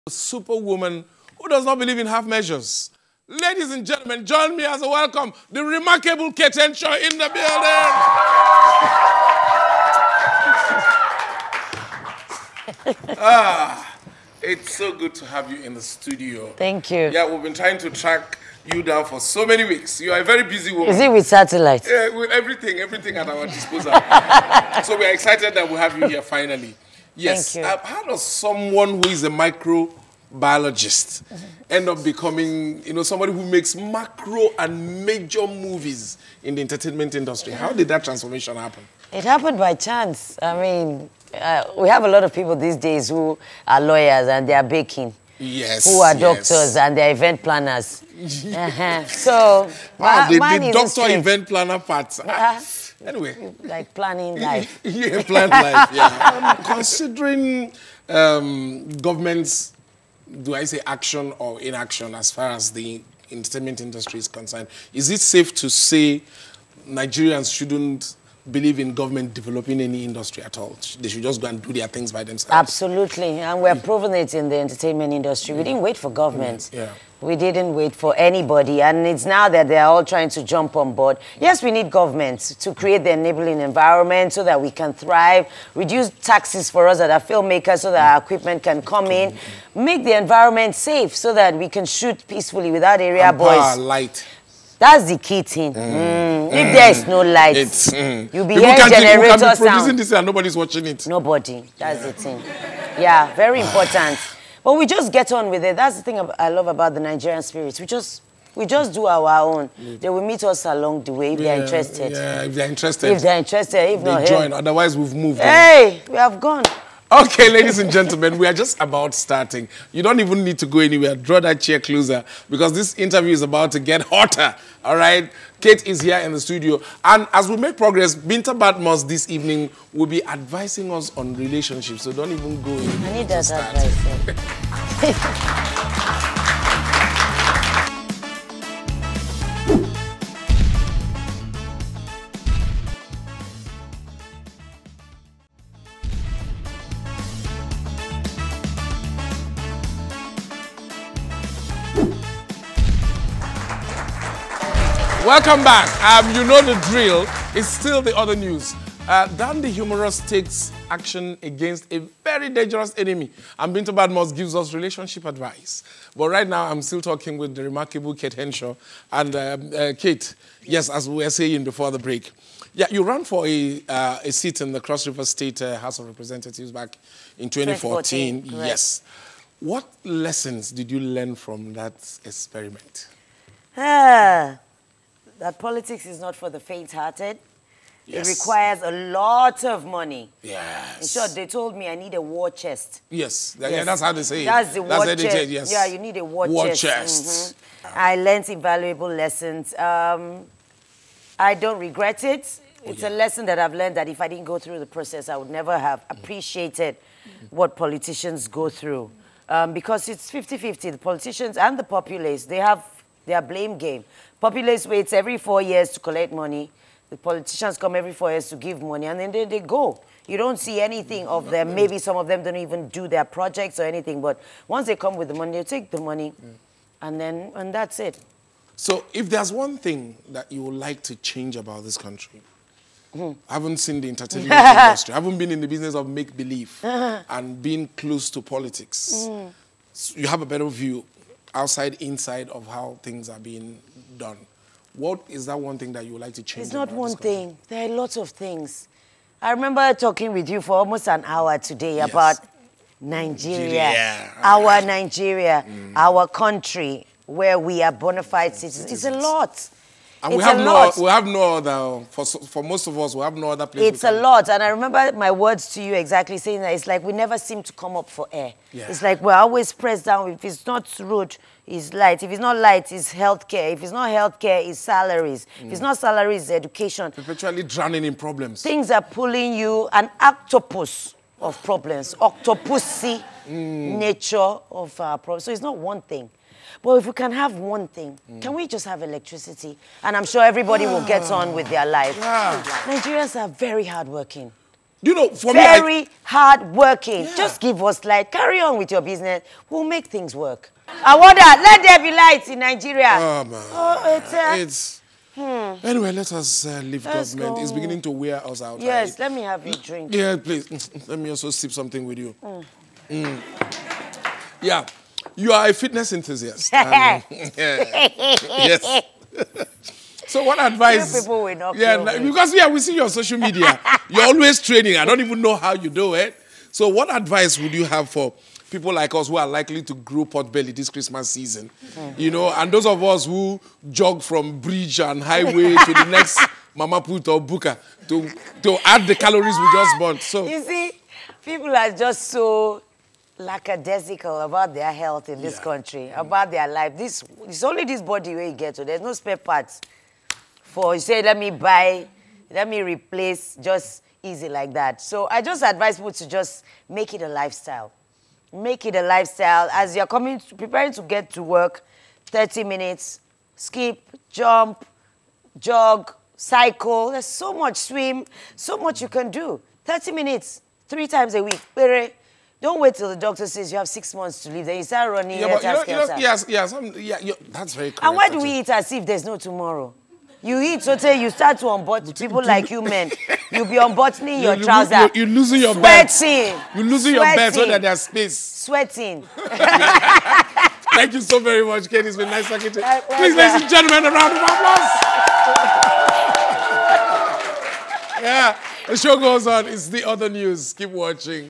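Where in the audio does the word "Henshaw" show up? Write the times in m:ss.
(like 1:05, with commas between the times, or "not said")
0:06, 2:48.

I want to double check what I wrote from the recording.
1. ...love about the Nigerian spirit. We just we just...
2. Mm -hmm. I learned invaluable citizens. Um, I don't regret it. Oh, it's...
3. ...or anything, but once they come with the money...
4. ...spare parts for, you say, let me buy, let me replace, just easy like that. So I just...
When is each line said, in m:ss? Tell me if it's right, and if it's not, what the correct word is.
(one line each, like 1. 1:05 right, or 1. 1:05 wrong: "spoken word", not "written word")
1. 1:46 right
2. 3:17 wrong: "lessons", not "citizens"
3. 3:43 right
4. 5:49 right.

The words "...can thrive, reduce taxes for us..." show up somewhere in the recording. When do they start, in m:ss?
1:24.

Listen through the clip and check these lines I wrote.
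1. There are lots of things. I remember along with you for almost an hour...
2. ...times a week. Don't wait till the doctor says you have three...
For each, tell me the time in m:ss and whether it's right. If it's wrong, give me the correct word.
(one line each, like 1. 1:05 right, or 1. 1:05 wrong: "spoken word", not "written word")
1. 4:07 wrong: "talking", not "along"
2. 6:11 wrong: "six", not "three".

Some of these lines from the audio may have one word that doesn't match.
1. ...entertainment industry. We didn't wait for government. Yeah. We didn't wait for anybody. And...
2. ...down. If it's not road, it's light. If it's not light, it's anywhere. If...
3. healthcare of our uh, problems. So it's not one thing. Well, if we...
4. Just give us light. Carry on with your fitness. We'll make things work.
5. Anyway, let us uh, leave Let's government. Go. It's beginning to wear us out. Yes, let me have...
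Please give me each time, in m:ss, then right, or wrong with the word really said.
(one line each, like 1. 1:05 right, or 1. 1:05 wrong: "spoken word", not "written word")
1. 1:14 right
2. 4:30 wrong: "healthcare", not "anywhere"
3. 4:43 wrong: "nature", not "healthcare"
4. 4:57 wrong: "business", not "fitness"
5. 5:05 right.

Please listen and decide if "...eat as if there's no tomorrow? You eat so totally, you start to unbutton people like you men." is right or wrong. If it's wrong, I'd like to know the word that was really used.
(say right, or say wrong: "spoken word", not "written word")
right.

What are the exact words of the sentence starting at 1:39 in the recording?
can be producing this and nobody's watching it.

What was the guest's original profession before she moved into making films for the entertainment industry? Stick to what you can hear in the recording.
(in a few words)
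Microbiologist.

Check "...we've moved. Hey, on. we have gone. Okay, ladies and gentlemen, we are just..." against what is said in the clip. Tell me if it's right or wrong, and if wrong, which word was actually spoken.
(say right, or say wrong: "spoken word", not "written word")
right.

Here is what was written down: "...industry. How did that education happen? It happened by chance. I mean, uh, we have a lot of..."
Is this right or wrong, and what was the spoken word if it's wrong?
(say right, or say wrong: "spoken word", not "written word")
wrong: "transformation", not "education".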